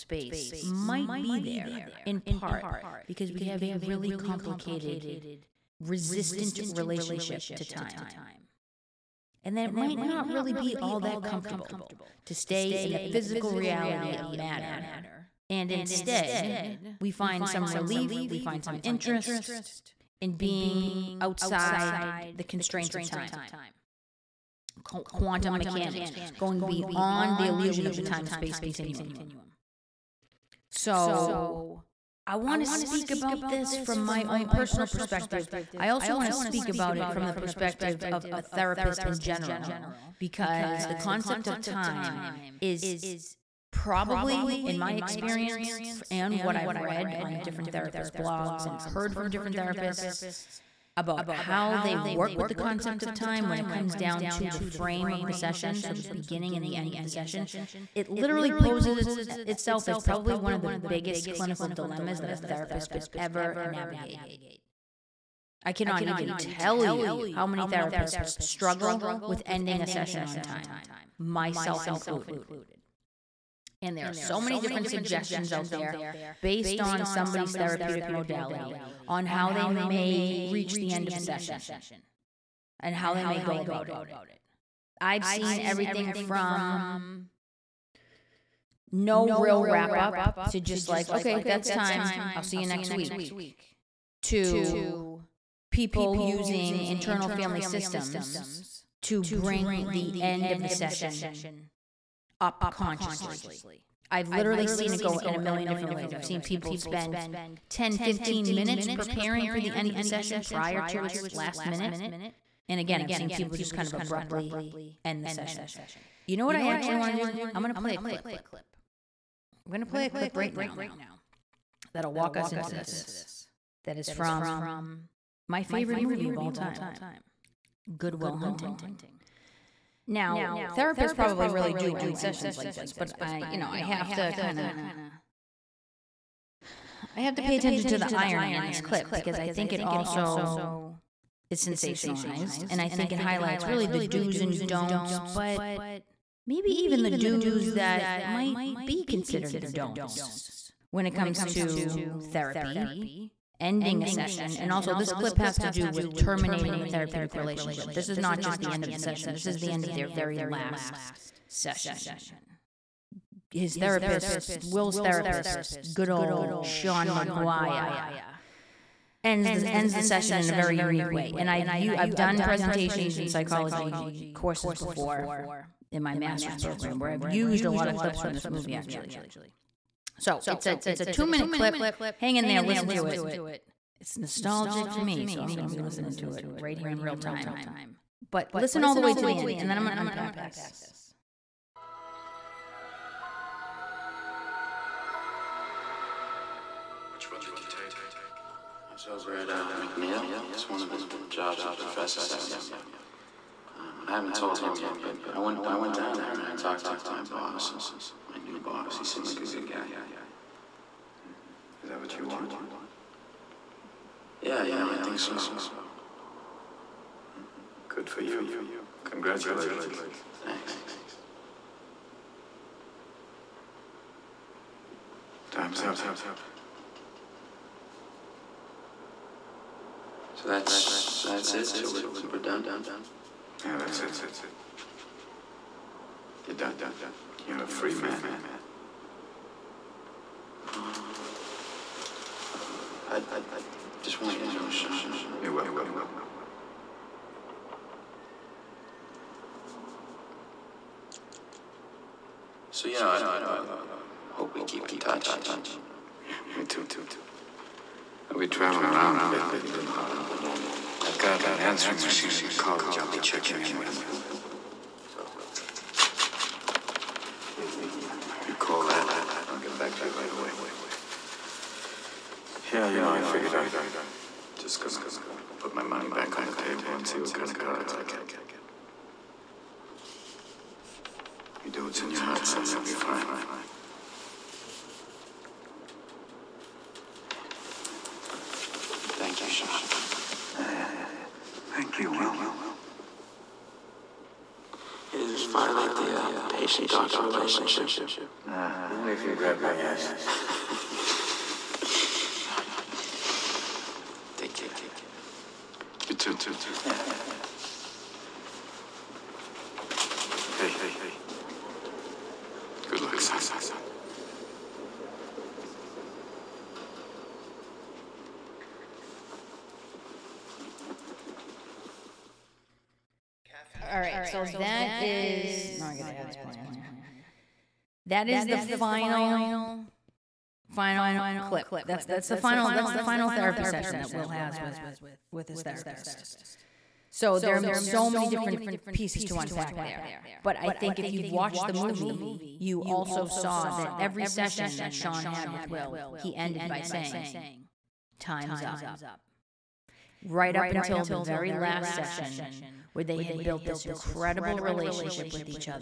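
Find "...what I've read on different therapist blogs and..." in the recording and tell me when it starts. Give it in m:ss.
0:46.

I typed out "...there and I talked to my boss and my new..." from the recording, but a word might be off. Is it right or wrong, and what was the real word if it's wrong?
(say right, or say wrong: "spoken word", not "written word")
right.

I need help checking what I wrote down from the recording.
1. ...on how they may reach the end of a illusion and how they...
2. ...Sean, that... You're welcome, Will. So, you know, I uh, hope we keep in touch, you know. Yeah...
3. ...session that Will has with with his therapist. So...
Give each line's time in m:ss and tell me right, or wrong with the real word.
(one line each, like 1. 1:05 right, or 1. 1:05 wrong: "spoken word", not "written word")
1. 1:19 wrong: "session", not "illusion"
2. 4:04 right
3. 5:33 right.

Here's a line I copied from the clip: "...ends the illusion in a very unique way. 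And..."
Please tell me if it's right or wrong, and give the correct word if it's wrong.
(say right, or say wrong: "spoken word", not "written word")
wrong: "session", not "illusion".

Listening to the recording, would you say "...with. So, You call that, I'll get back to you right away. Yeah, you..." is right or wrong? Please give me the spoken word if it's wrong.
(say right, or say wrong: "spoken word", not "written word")
right.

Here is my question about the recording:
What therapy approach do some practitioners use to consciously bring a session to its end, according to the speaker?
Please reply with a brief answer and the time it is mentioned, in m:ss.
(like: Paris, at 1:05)
Internal family systems, at 1:36.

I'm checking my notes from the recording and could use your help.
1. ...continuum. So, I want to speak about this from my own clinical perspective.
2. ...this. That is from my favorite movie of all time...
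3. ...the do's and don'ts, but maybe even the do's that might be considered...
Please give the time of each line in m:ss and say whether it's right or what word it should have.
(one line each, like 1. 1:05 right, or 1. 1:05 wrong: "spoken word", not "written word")
1. 0:28 wrong: "personal", not "clinical"
2. 2:02 right
3. 2:23 right.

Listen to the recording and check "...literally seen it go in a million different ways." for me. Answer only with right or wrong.
right.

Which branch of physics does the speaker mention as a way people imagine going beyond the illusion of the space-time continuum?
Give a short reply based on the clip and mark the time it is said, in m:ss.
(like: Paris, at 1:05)
Quantum mechanics, at 0:25.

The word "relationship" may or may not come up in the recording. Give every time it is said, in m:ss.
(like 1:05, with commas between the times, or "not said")
0:06, 2:37, 4:57, 5:54.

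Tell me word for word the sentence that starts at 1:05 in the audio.
I cannot even tell you how many therapists struggle with ending a session on time, myself included.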